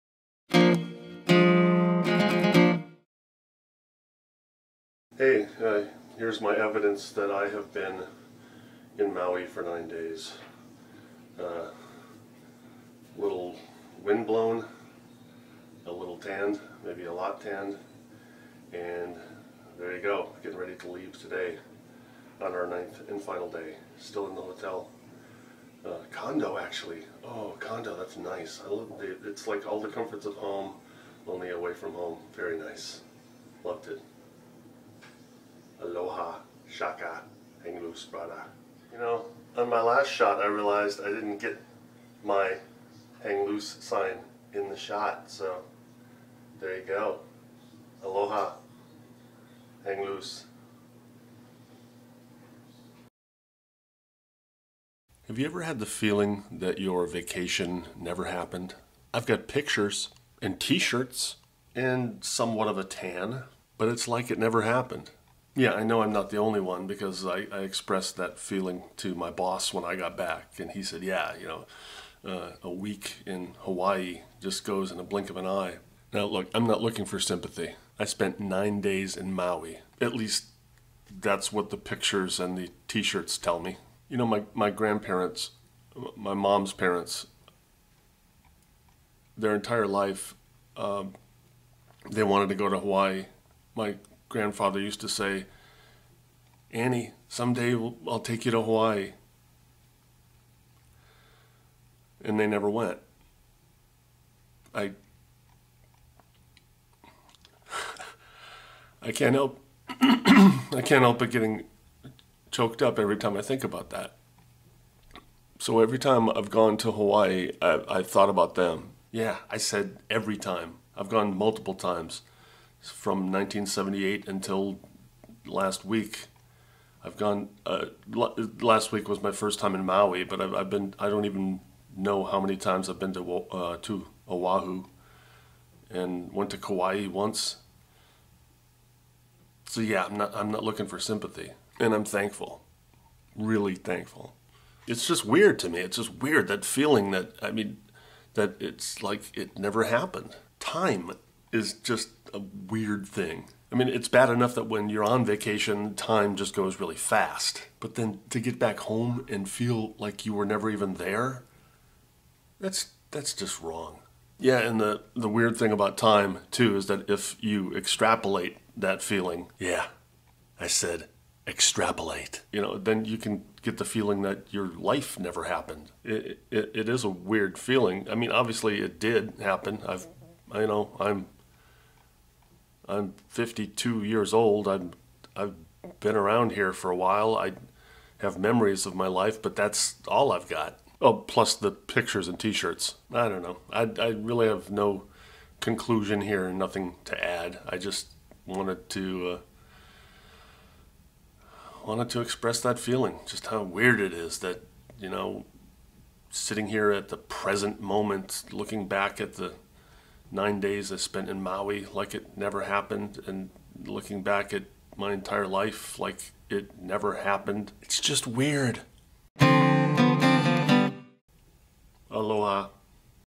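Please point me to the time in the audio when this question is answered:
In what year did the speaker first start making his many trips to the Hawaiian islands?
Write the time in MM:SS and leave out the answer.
02:03.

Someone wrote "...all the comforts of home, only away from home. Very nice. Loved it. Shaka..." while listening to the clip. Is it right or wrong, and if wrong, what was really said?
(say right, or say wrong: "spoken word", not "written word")
right.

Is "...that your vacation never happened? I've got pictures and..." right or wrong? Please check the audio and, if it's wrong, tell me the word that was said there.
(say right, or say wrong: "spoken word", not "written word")
right.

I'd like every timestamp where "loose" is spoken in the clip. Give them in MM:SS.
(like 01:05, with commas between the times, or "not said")
00:37, 00:43, 00:50.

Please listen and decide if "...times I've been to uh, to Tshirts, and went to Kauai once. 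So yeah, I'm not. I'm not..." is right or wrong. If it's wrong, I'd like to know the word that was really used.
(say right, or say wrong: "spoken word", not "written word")
wrong: "Oahu", not "Tshirts".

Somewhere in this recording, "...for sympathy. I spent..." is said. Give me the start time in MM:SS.
01:17.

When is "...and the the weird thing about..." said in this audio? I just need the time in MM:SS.
02:44.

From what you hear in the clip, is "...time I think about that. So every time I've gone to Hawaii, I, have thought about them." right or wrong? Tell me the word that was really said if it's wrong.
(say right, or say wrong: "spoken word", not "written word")
right.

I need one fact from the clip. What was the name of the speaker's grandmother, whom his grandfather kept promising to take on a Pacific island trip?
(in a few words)
Annie.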